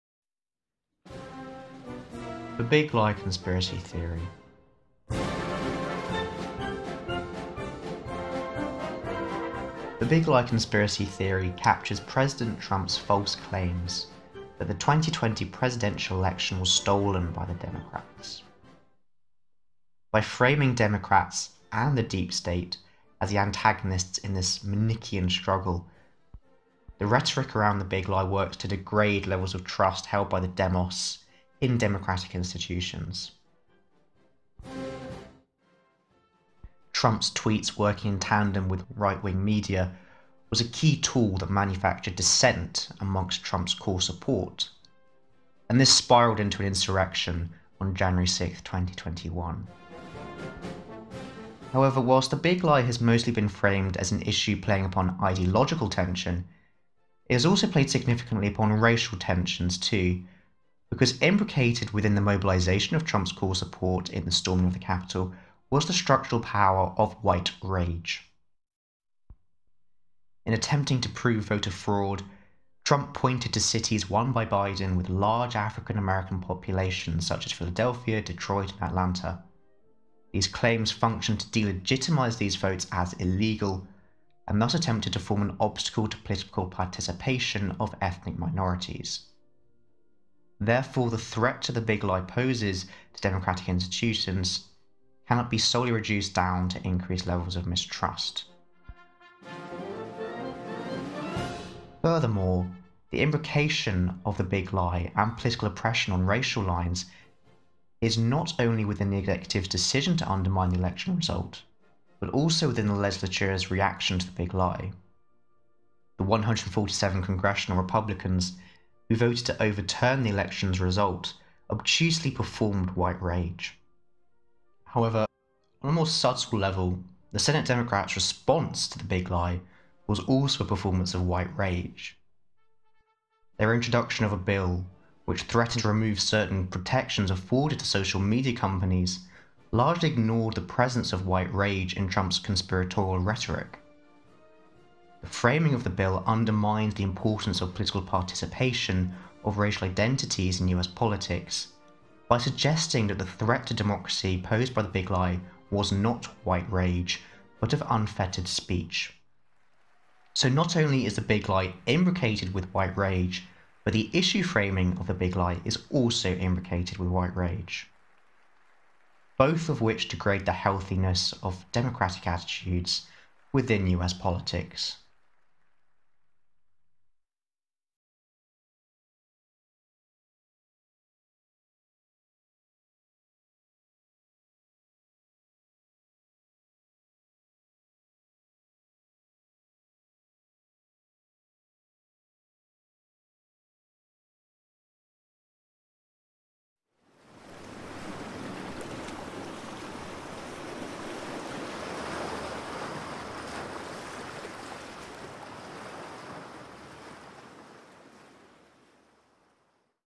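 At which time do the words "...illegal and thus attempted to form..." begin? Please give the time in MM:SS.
01:23.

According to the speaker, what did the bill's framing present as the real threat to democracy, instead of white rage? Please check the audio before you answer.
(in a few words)
Unfettered speech.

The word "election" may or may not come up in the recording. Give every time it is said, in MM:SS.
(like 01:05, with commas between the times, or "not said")
00:16, 01:50, 02:00.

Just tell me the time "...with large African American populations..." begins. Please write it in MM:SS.
01:14.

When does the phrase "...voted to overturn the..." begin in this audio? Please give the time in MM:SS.
01:59.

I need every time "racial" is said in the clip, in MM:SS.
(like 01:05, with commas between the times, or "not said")
00:58, 01:46, 02:29.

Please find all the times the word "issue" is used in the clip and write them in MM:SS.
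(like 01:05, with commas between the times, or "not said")
00:54, 02:44.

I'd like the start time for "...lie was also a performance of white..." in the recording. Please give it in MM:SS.
02:09.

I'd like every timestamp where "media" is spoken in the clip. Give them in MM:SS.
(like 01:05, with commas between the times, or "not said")
00:39, 02:18.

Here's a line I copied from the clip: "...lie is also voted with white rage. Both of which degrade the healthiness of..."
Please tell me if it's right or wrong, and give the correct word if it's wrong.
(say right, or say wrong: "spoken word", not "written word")
wrong: "imbricated", not "voted".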